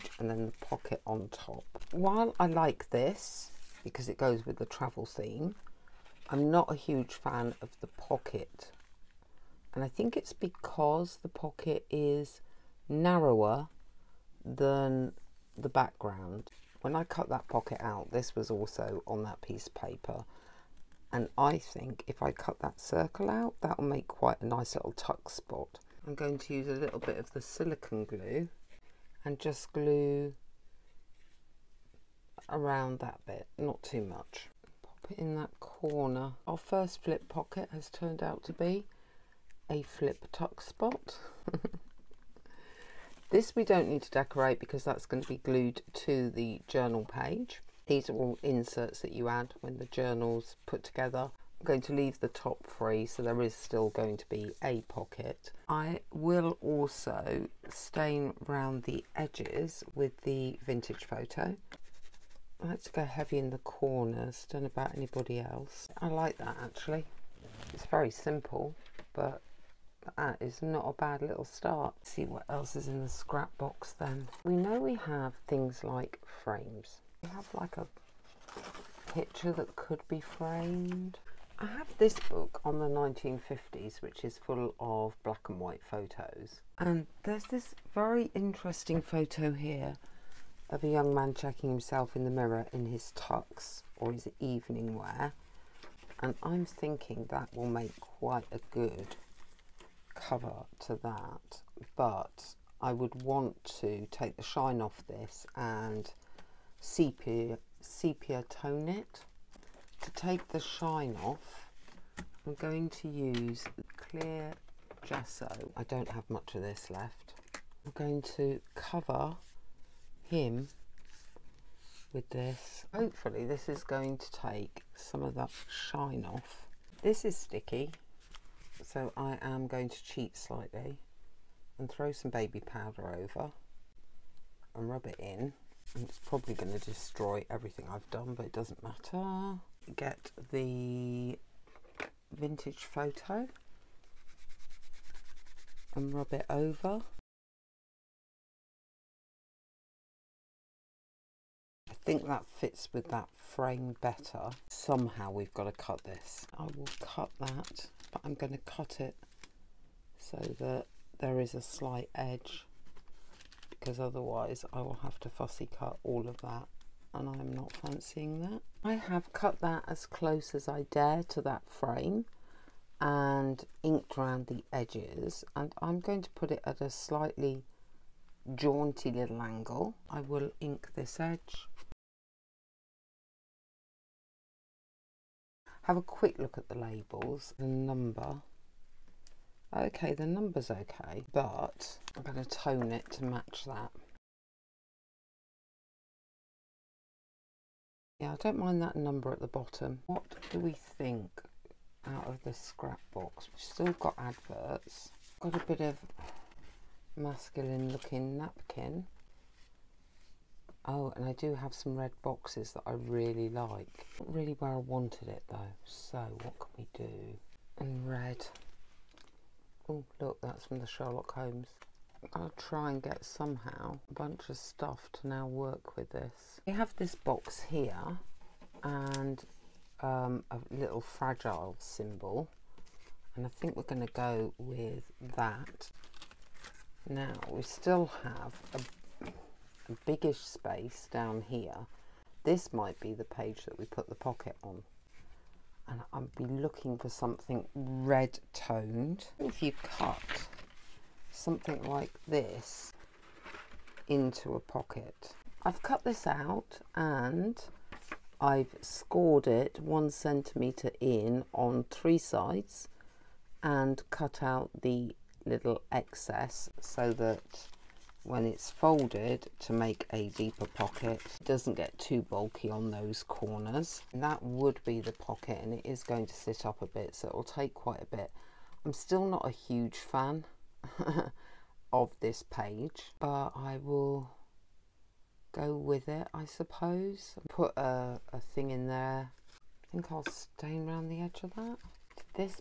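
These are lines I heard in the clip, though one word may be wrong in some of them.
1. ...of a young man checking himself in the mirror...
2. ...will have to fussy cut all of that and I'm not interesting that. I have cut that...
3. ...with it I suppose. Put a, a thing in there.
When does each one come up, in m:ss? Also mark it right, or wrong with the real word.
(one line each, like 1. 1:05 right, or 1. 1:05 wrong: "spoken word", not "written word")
1. 1:30 right
2. 2:44 wrong: "fancying", not "interesting"
3. 4:45 right.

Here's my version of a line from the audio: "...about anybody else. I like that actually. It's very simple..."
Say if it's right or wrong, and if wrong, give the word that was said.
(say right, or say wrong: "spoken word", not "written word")
right.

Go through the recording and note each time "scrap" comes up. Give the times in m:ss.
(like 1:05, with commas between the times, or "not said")
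1:13, 3:22.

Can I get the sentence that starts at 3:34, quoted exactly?
Not really where I wanted it though.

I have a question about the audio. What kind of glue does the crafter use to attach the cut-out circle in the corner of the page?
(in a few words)
silicone glue.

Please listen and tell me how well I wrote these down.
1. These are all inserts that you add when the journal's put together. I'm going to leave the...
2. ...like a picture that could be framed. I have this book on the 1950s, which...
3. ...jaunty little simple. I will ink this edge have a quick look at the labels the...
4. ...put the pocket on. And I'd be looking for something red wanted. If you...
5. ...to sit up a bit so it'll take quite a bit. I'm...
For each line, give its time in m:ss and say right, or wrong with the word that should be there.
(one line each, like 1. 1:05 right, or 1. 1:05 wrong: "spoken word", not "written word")
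1. 0:47 right
2. 1:17 right
3. 2:58 wrong: "angle", not "simple"
4. 4:03 wrong: "toned", not "wanted"
5. 4:36 right.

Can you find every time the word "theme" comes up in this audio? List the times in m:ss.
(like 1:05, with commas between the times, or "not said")
0:05.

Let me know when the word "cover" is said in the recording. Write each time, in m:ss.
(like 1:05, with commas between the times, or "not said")
1:40, 1:58.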